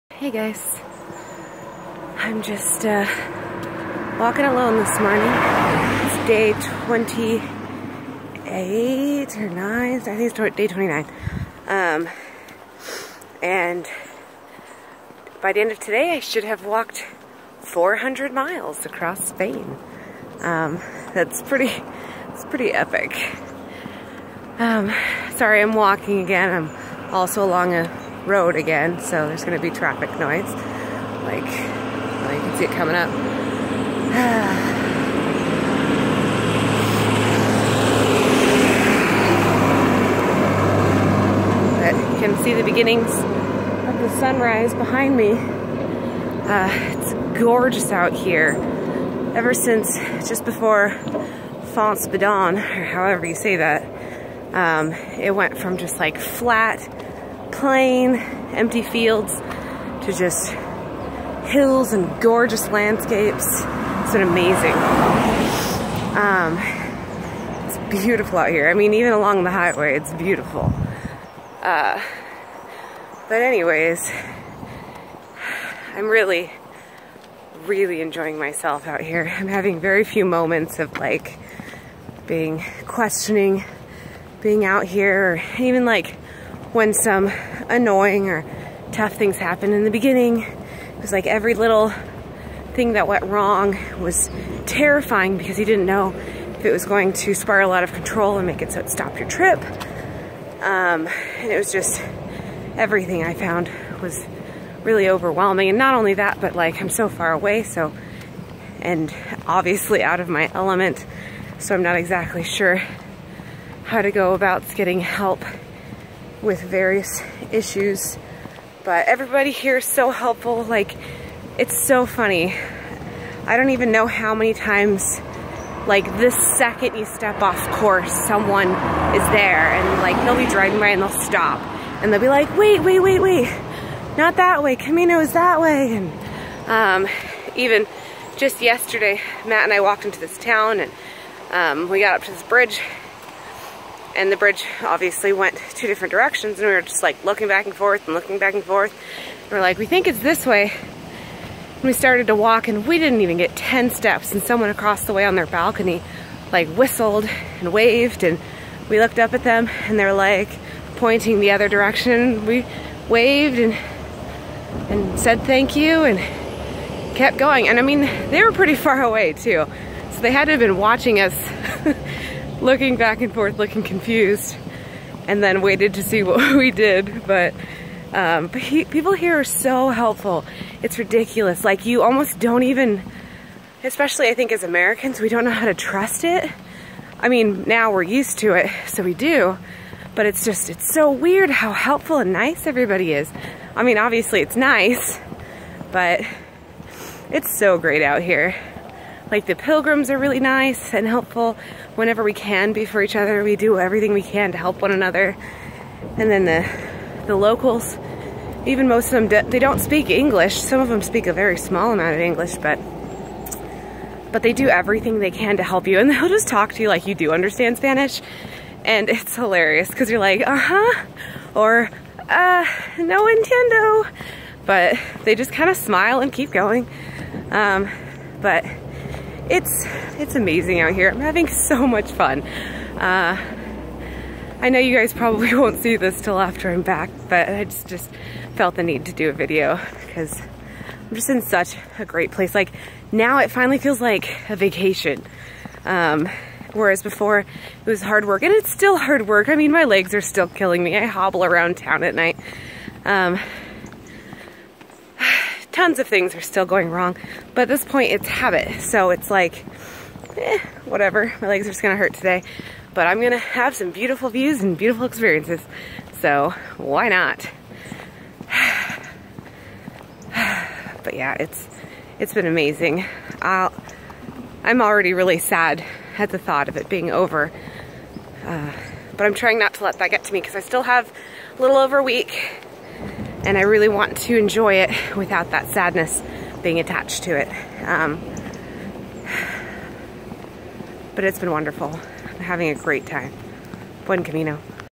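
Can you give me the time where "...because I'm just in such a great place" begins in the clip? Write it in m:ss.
4:00.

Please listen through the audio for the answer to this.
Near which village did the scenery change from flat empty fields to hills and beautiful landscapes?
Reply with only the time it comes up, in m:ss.
0:51.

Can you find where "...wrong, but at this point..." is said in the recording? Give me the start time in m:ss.
4:16.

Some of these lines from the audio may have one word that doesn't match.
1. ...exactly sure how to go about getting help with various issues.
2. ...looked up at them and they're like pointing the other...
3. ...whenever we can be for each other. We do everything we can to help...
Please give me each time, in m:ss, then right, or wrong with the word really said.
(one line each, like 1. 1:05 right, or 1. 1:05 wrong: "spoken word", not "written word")
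1. 1:51 right
2. 2:38 right
3. 3:21 right.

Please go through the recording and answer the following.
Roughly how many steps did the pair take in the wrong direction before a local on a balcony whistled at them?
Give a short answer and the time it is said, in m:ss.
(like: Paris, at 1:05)
10, at 2:33.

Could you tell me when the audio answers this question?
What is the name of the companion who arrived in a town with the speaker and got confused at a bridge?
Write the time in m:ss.
2:19.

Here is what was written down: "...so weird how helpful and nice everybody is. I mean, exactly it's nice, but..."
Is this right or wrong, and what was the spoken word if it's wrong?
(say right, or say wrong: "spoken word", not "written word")
wrong: "obviously", not "exactly".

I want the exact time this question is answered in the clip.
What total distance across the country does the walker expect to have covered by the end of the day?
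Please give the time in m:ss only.
0:17.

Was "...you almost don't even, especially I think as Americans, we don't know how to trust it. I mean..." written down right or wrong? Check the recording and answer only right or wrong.
right.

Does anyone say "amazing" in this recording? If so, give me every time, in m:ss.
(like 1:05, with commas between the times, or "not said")
1:04, 3:50, 4:32.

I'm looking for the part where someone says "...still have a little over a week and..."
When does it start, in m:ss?
4:40.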